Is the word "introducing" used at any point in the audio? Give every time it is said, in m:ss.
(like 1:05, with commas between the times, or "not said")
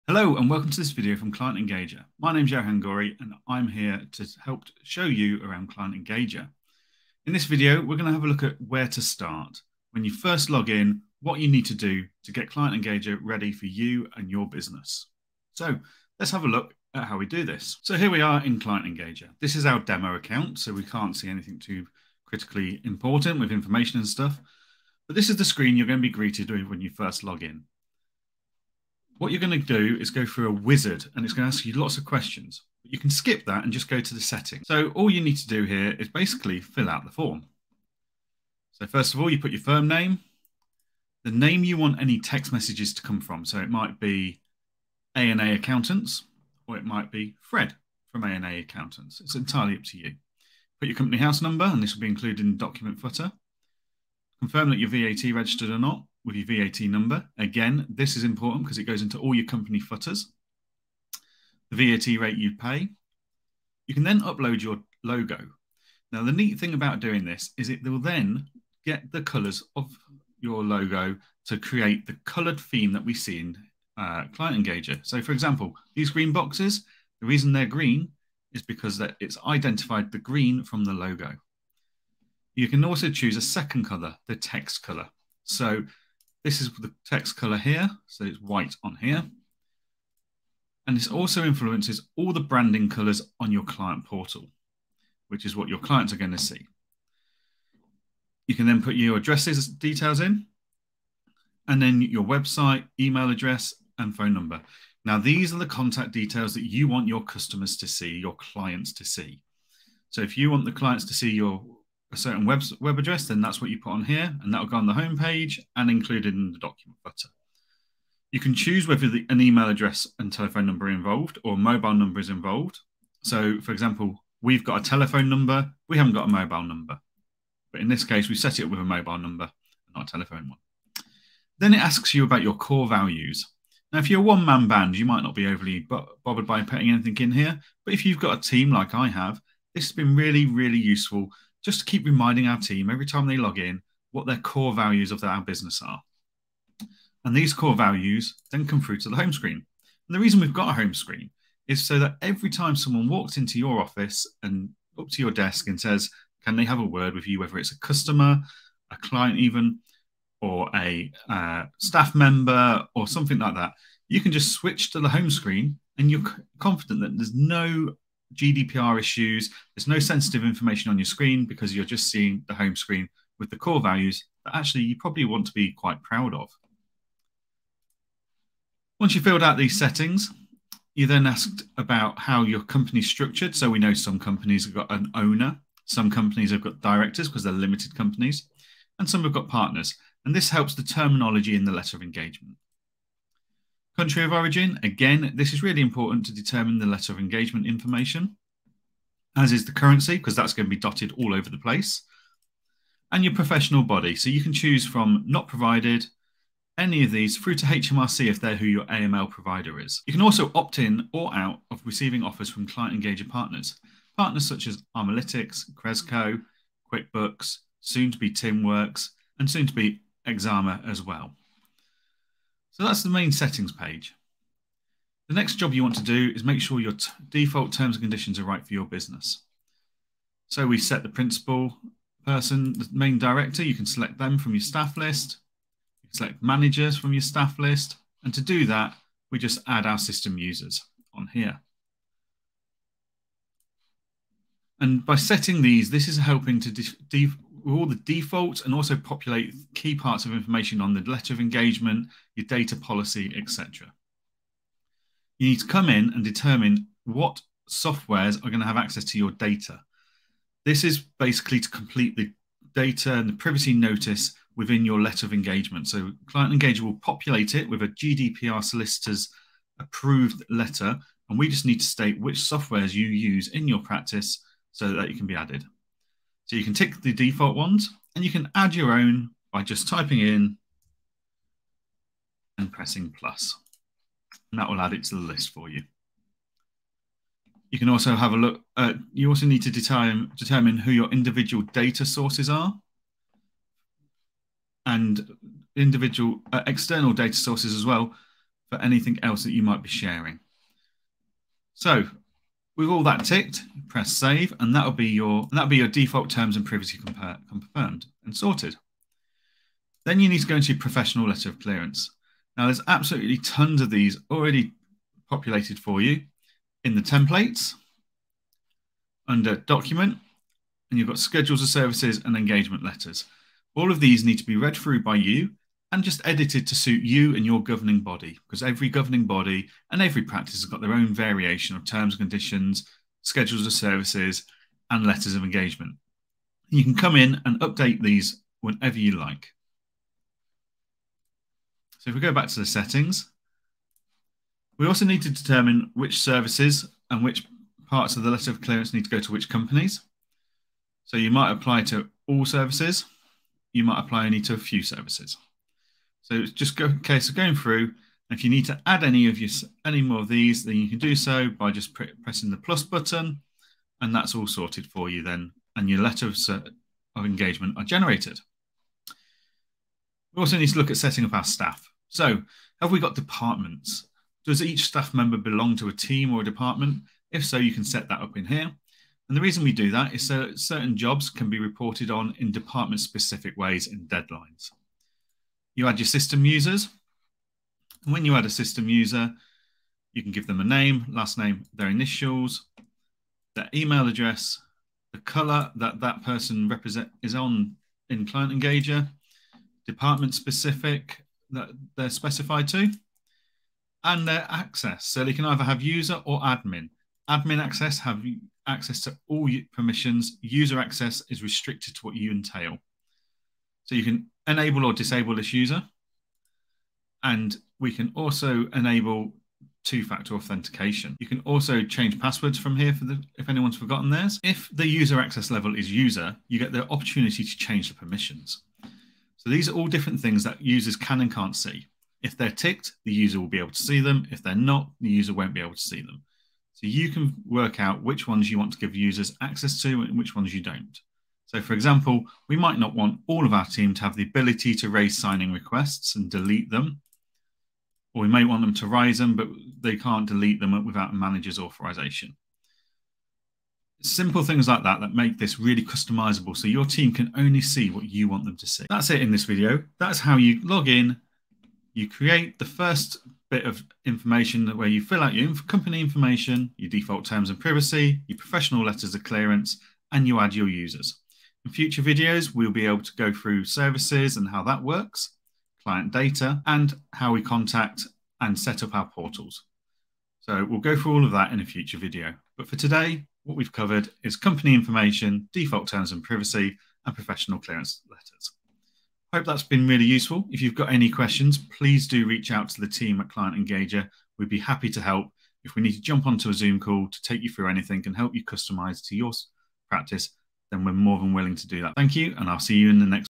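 not said.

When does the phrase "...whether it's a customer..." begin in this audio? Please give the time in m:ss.
2:37.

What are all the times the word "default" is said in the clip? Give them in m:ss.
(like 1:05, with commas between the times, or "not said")
3:47, 4:08, 4:37, 5:05, 7:46, 8:05.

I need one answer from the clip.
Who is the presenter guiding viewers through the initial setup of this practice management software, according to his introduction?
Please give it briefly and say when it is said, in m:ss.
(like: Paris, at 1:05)
Johan Gori, at 0:02.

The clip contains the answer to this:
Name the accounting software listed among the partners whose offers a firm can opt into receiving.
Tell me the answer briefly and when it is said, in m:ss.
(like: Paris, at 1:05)
QuickBooks, at 3:36.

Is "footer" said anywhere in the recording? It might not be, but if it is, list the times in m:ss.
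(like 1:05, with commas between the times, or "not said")
0:52, 0:59, 1:57.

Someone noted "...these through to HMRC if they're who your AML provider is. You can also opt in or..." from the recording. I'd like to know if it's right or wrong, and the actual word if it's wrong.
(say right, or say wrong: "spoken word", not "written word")
right.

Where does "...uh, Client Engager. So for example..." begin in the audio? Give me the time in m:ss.
1:13.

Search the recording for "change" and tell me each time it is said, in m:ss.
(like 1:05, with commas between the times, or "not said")
7:01, 7:07.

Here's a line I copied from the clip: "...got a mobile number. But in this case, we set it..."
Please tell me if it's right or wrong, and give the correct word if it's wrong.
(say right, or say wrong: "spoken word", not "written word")
right.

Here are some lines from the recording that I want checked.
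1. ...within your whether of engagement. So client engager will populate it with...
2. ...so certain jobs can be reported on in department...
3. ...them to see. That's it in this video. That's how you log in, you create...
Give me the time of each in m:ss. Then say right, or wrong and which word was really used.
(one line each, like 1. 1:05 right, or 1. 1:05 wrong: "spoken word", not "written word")
1. 4:24 wrong: "letter", not "whether"
2. 6:20 right
3. 7:38 right.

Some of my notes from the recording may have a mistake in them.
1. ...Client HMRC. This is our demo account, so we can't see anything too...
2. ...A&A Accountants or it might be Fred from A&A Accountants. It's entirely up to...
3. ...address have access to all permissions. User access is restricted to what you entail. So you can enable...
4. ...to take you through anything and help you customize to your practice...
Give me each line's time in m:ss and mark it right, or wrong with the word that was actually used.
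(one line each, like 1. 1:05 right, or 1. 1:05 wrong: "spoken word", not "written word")
1. 0:18 wrong: "Engager", not "HMRC"
2. 0:45 right
3. 6:47 wrong: "access", not "address"
4. 8:17 right.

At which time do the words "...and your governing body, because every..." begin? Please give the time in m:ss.
5:27.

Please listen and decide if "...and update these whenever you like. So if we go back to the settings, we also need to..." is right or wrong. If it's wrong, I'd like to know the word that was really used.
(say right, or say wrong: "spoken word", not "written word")
right.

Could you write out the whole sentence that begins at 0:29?
What you're going to do is go through a wizard and it's going to ask you lots of questions.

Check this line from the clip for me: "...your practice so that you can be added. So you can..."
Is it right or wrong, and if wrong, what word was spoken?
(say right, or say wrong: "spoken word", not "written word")
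right.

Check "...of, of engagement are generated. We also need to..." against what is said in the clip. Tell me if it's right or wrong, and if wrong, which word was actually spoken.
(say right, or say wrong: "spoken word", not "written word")
right.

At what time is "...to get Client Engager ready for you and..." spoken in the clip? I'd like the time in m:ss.
0:12.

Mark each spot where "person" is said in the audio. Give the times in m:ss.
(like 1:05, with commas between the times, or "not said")
3:52, 6:36.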